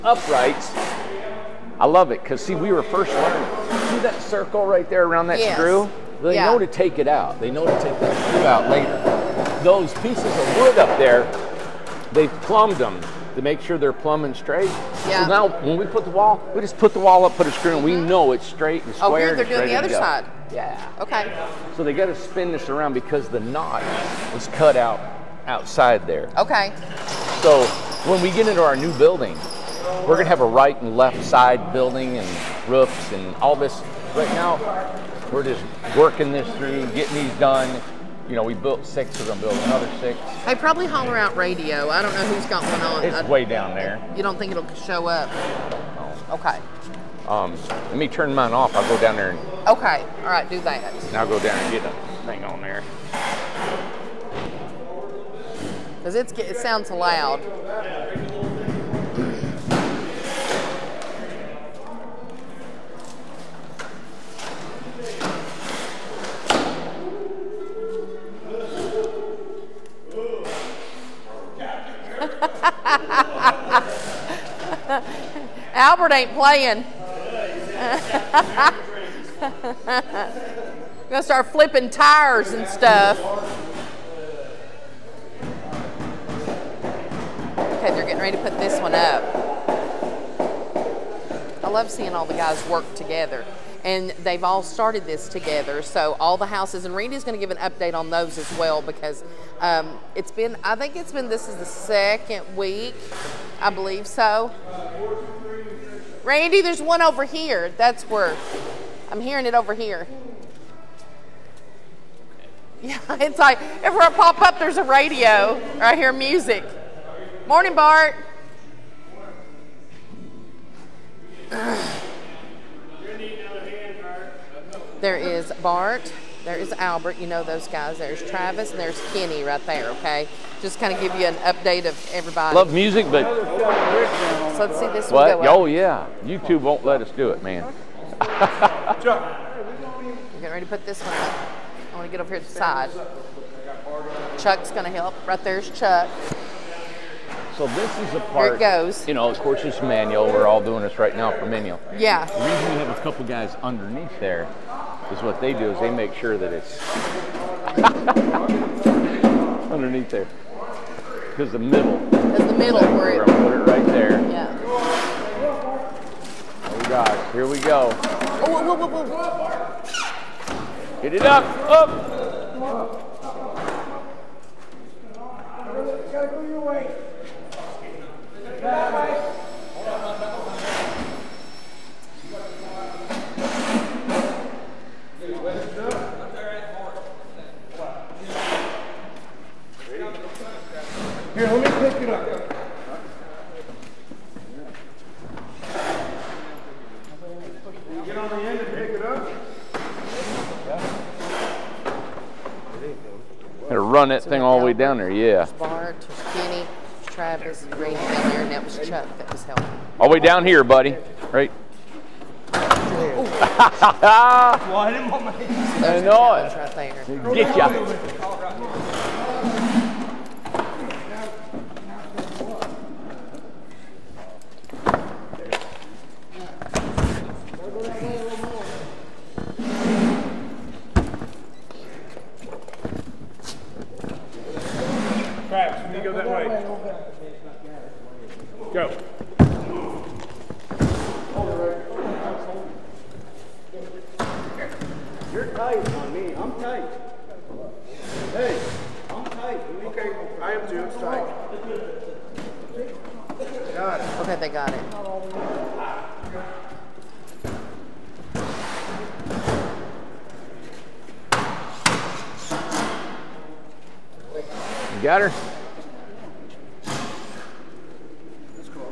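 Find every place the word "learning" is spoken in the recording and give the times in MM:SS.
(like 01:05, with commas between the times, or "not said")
00:03.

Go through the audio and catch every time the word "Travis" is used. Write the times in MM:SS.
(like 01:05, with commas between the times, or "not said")
02:08, 03:27.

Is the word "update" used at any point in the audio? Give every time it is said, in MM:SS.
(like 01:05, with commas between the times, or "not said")
01:37, 02:11.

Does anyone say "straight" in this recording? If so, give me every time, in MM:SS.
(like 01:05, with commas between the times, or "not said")
00:14, 00:18.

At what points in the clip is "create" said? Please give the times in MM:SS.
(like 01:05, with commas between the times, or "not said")
not said.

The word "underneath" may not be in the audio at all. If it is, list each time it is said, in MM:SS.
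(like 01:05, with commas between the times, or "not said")
02:33, 02:39.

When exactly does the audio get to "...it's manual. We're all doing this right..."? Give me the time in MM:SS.
02:29.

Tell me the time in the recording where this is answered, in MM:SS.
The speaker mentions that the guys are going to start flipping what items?
01:21.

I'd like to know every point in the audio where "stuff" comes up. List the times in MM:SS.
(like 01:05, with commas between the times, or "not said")
01:22.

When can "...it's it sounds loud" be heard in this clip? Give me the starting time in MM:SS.
00:56.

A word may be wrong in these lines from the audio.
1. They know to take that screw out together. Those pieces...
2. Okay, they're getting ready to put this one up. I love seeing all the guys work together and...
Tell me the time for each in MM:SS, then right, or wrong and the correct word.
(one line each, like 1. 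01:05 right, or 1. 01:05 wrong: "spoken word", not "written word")
1. 00:07 wrong: "later", not "together"
2. 01:27 right.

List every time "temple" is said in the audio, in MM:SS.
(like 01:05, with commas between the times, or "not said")
not said.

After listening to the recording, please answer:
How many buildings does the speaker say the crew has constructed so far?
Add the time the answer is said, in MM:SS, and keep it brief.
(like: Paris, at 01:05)
6, at 00:38.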